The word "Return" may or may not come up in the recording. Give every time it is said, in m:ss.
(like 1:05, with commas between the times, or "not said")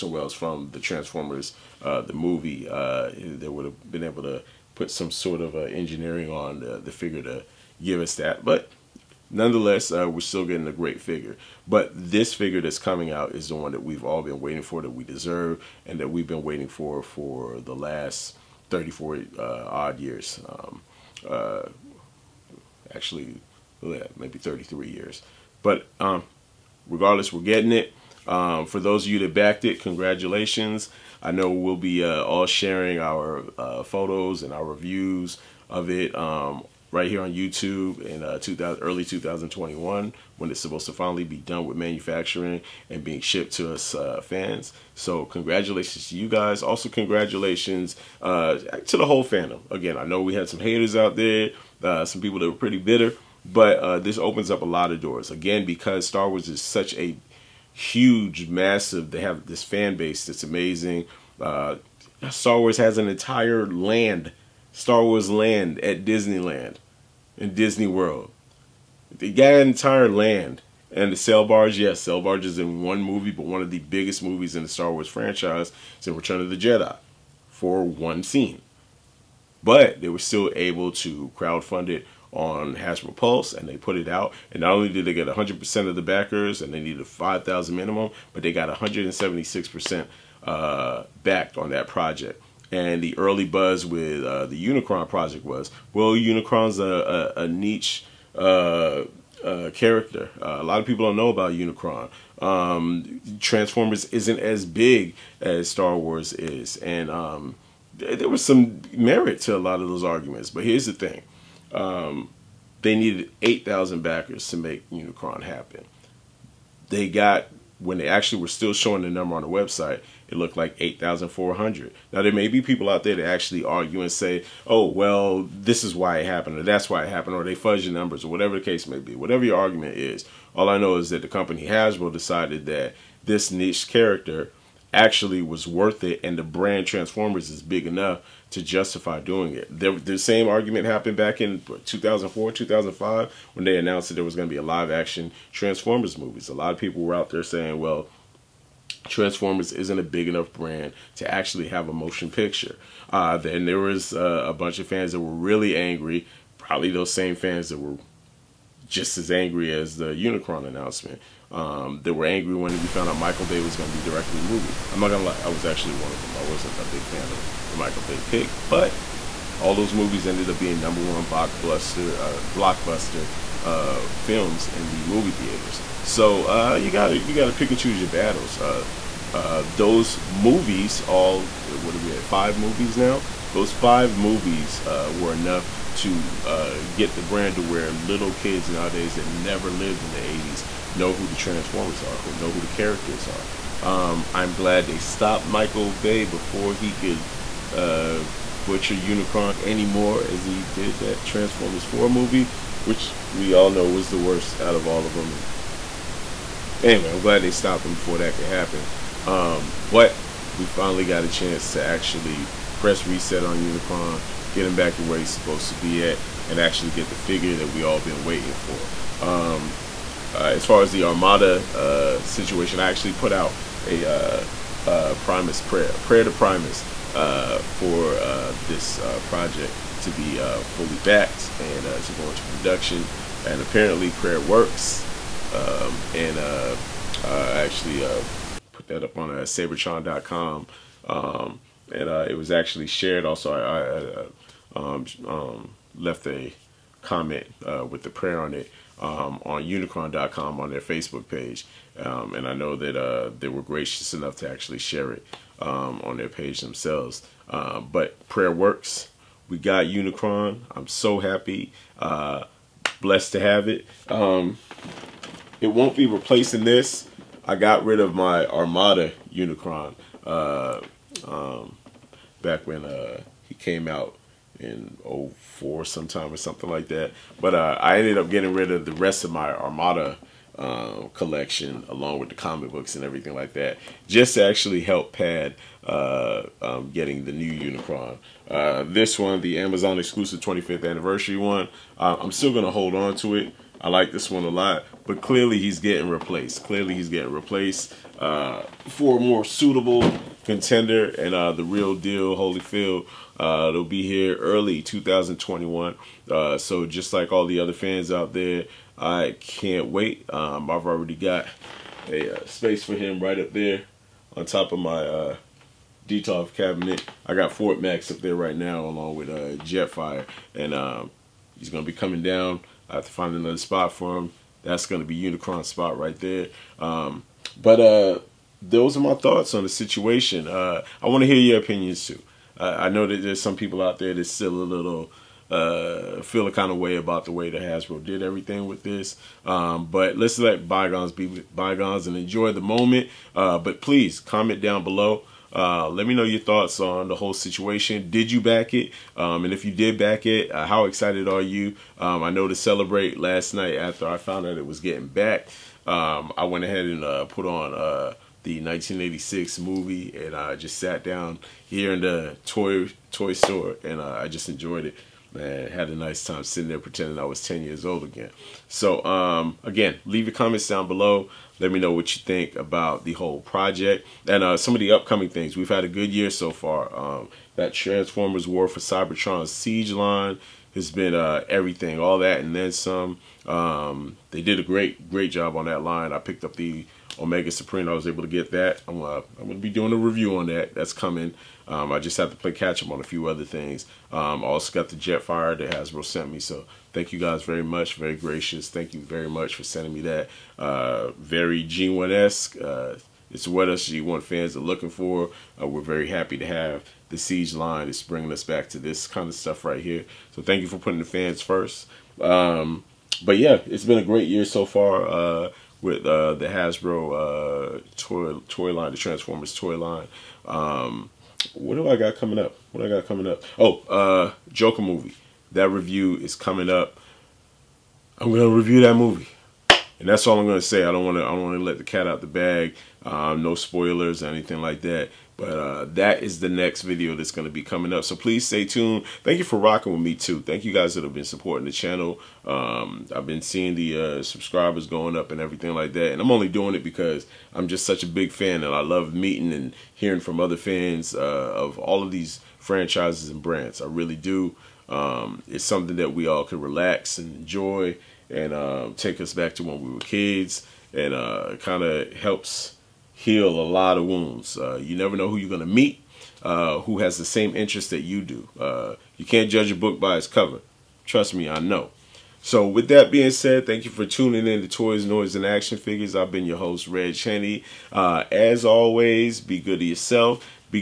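1:16.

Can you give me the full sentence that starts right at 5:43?
Uh, but please comment down below.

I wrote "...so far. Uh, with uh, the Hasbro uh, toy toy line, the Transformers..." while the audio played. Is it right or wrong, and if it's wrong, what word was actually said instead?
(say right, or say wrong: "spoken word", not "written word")
right.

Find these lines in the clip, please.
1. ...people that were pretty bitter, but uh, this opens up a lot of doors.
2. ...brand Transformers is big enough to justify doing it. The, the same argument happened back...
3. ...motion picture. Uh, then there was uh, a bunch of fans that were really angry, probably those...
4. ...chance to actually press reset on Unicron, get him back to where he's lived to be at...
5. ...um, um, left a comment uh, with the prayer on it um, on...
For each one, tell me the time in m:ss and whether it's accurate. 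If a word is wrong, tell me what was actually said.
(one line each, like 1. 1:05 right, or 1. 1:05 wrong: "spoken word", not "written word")
1. 0:52 right
2. 2:16 right
3. 2:31 right
4. 3:31 wrong: "supposed", not "lived"
5. 4:04 right.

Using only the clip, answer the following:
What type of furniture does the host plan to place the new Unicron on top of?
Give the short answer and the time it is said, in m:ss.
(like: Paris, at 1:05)
Detolf cabinet, at 5:16.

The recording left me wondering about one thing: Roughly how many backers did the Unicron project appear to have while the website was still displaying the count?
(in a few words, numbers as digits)
8,400.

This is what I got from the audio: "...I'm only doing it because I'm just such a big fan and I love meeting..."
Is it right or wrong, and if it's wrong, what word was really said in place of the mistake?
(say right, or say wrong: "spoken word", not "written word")
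right.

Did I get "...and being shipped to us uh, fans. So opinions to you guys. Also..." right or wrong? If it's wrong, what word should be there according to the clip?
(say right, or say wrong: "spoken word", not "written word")
wrong: "congratulations", not "opinions".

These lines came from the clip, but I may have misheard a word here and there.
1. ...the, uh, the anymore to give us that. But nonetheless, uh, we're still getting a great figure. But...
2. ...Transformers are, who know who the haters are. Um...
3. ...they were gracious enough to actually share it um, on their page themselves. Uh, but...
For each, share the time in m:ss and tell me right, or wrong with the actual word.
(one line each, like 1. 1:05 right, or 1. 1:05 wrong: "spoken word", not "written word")
1. 0:06 wrong: "figure", not "anymore"
2. 3:11 wrong: "characters", not "haters"
3. 4:13 right.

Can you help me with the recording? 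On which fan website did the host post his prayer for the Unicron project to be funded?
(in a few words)
Seibertron.com.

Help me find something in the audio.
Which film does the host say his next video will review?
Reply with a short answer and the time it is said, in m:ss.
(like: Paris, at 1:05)
Joker, at 7:04.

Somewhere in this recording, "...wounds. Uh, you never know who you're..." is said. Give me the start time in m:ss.
7:44.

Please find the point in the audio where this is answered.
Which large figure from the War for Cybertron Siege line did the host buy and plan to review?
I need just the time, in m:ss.
6:27.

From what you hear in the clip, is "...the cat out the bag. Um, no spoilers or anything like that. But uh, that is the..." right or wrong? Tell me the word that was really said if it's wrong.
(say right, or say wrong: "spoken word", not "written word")
right.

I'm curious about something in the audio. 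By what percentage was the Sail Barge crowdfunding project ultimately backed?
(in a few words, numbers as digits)
176%.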